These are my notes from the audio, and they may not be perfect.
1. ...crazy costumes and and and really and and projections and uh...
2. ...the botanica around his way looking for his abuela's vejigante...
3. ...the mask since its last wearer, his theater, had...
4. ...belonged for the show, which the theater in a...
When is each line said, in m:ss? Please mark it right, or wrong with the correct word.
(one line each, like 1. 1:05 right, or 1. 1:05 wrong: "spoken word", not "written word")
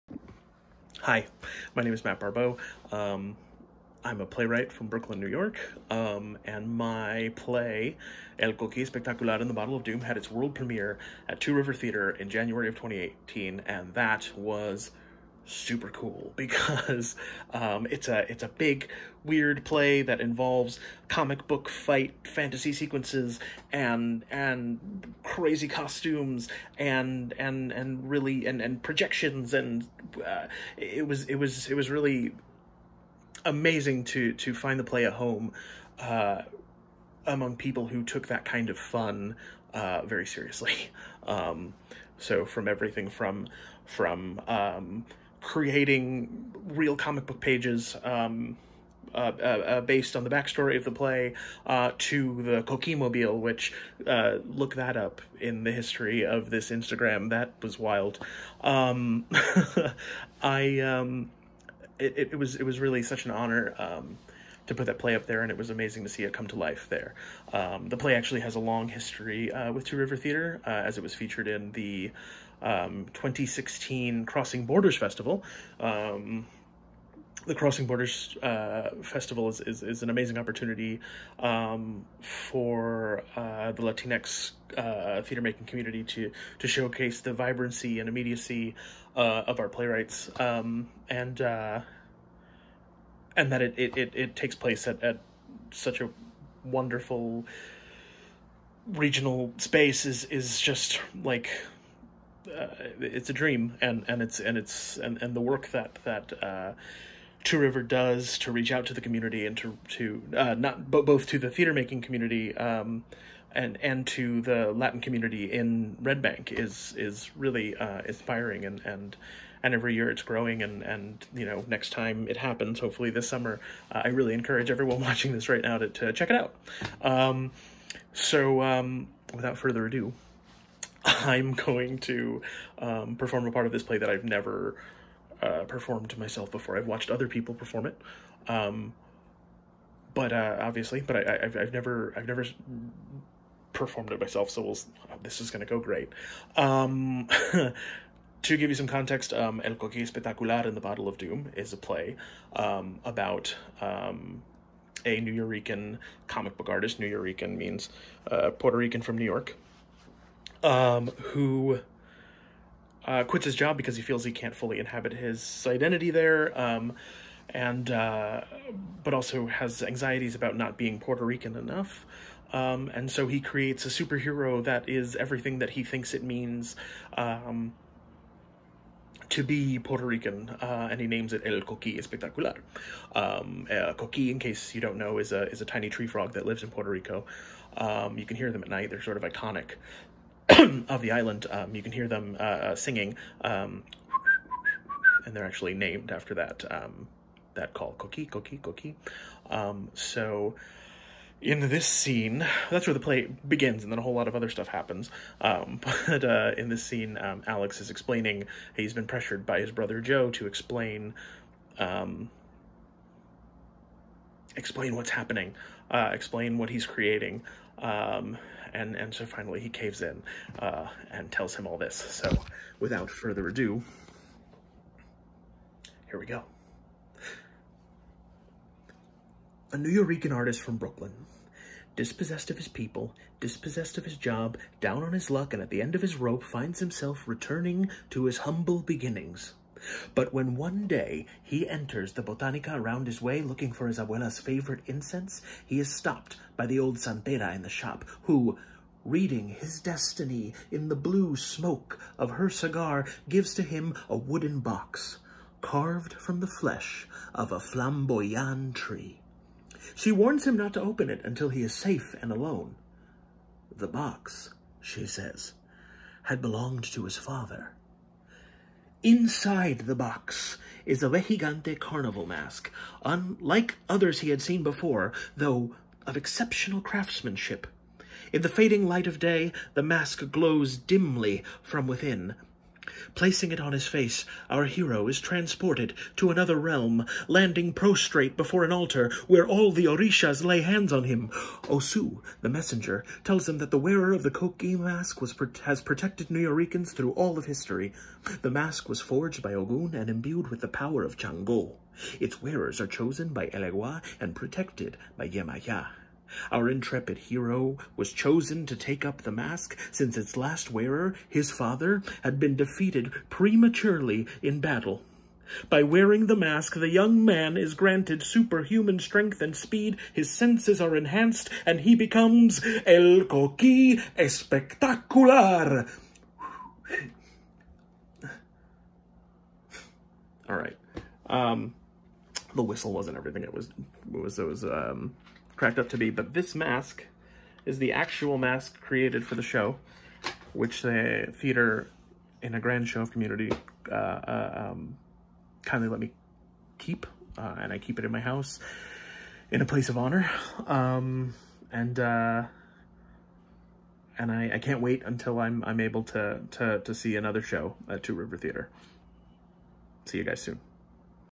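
1. 0:25 right
2. 4:02 wrong: "favorite", not "vejigante"
3. 5:09 wrong: "father", not "theater"
4. 5:38 wrong: "created", not "belonged".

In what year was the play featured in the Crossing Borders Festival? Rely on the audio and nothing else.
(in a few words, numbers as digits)
2016.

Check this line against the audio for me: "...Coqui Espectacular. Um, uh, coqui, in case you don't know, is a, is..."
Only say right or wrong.
right.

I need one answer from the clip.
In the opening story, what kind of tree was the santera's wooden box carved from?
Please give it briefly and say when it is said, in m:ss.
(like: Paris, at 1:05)
flamboyant tree, at 4:17.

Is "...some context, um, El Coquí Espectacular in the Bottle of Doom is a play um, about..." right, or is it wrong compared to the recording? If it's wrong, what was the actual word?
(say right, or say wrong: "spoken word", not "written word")
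right.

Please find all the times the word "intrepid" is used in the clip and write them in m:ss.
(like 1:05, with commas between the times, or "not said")
5:06.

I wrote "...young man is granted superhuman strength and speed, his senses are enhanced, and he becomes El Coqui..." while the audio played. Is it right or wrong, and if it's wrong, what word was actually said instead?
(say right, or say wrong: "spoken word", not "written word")
right.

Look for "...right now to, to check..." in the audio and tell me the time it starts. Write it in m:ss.
2:05.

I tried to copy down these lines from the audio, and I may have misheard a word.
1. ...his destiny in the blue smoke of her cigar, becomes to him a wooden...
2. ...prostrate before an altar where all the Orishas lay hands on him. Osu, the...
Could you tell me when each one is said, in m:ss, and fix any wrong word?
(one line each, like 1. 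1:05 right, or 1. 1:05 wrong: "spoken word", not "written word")
1. 4:09 wrong: "gives", not "becomes"
2. 4:47 right.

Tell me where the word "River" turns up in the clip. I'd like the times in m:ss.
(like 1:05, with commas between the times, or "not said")
0:11, 1:09, 1:47, 5:58.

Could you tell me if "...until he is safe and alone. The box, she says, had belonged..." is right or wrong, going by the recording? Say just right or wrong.
right.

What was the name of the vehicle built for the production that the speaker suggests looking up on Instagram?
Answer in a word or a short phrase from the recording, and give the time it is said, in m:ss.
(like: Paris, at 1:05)
coquimobile, at 0:52.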